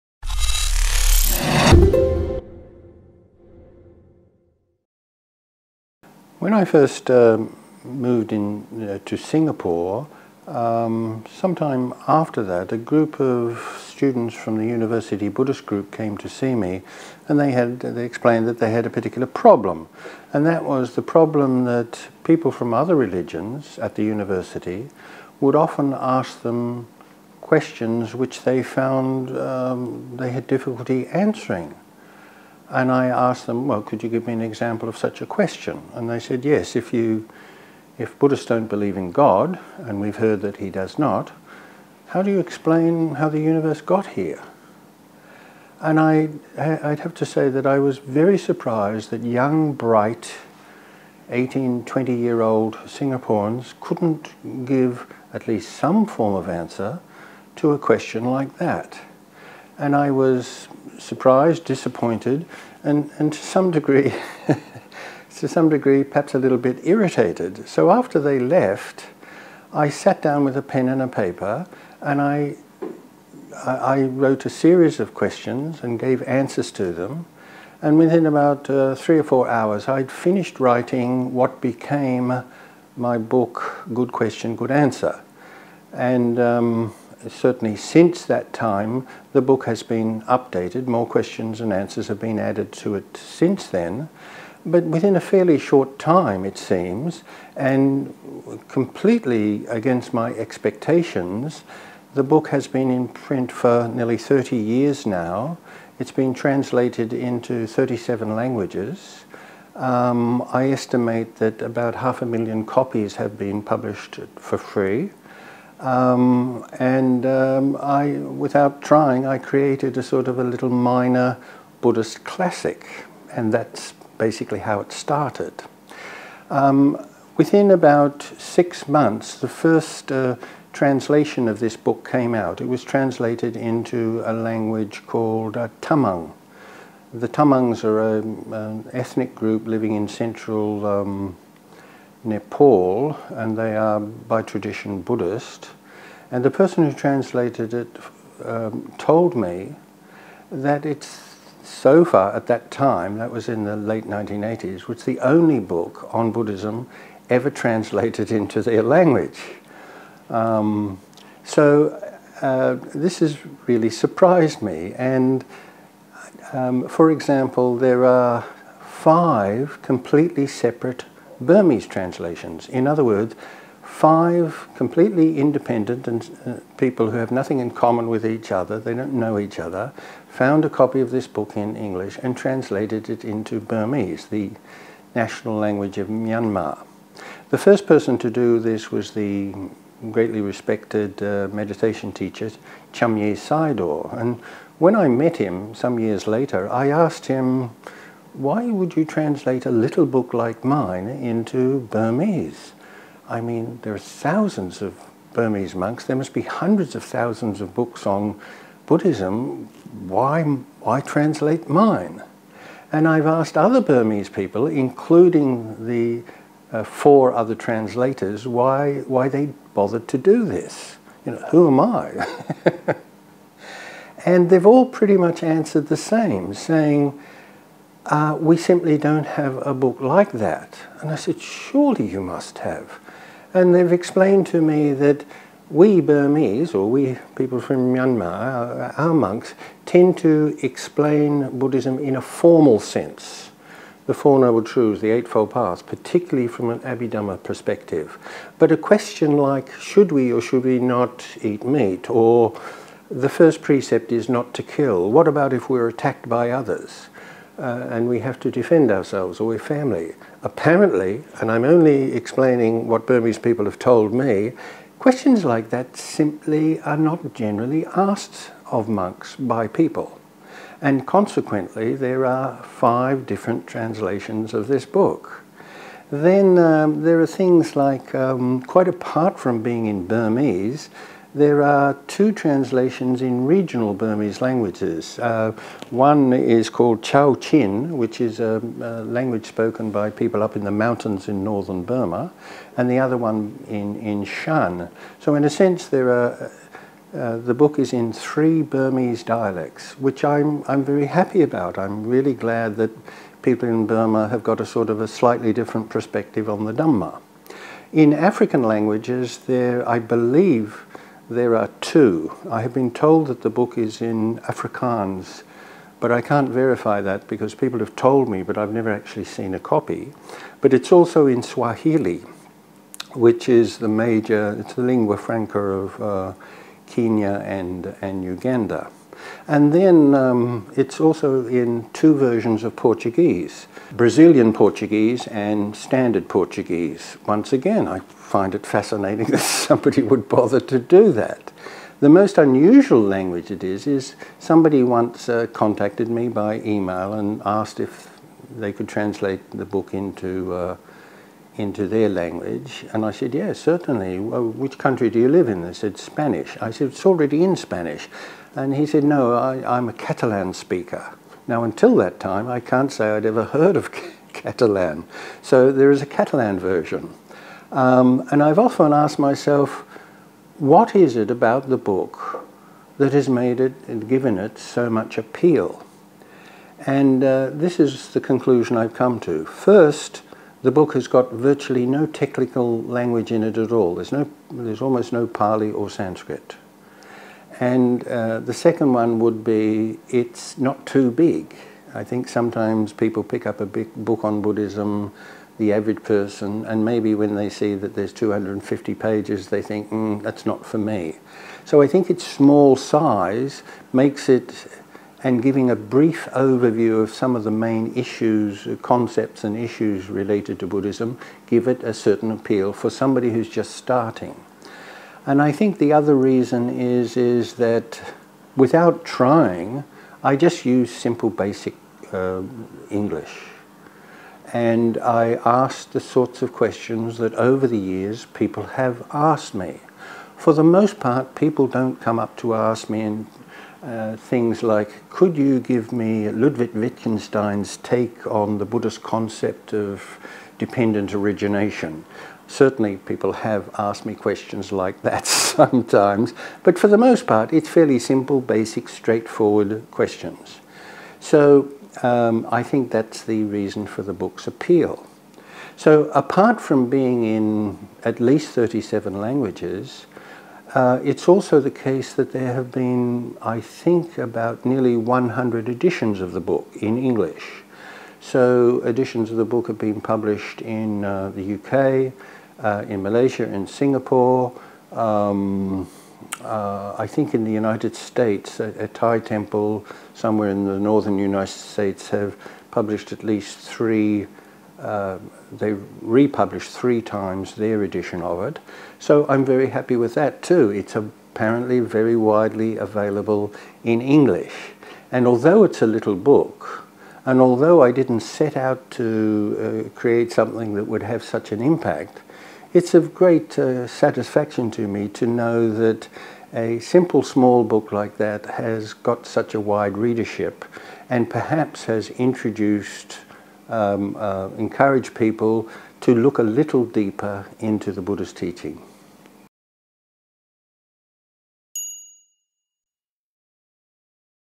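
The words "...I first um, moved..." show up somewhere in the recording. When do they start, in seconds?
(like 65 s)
6 s.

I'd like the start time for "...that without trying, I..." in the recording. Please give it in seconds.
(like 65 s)
417 s.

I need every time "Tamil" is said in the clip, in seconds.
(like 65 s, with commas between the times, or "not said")
not said.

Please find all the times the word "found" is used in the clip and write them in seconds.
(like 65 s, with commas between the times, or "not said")
28 s, 180 s.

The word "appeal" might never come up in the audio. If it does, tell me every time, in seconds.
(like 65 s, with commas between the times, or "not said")
375 s, 412 s, 454 s.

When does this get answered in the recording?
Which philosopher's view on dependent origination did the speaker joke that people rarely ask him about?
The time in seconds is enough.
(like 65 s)
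436 s.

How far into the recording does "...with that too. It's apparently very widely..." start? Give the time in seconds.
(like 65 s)
489 s.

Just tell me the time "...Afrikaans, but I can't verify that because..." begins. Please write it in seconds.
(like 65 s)
314 s.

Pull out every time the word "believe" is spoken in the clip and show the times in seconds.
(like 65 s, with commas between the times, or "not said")
38 s, 309 s.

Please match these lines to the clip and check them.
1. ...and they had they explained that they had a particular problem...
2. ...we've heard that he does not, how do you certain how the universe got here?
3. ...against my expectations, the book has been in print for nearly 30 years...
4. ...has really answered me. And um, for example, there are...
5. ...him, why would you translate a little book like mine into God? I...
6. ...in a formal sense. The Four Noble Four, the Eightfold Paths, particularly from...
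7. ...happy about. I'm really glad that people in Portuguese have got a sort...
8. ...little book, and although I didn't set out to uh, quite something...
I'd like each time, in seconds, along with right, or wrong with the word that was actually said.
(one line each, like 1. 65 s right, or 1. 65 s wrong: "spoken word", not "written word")
1. 17 s right
2. 39 s wrong: "explain", not "certain"
3. 99 s right
4. 163 s wrong: "surprised", not "answered"
5. 197 s wrong: "Burmese", not "God"
6. 241 s wrong: "Truths", not "Four"
7. 301 s wrong: "Burma", not "Portuguese"
8. 495 s wrong: "create", not "quite".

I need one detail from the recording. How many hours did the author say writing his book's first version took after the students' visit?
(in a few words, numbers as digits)
3 or 4 hours.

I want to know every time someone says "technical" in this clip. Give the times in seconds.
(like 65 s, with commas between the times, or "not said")
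382 s.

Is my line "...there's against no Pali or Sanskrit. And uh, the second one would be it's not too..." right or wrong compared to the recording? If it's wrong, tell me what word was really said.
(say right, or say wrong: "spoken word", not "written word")
wrong: "almost", not "against".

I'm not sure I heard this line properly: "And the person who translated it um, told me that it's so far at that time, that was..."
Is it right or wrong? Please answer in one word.
right.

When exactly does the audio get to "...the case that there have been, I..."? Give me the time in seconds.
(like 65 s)
461 s.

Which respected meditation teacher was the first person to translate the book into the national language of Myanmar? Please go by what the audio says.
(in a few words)
Chanmyay Sayadaw.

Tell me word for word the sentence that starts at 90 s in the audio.
More questions and answers have been added to it since then.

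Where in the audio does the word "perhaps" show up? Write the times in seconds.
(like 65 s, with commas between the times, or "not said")
66 s, 511 s.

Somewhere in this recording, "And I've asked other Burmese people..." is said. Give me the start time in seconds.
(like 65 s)
212 s.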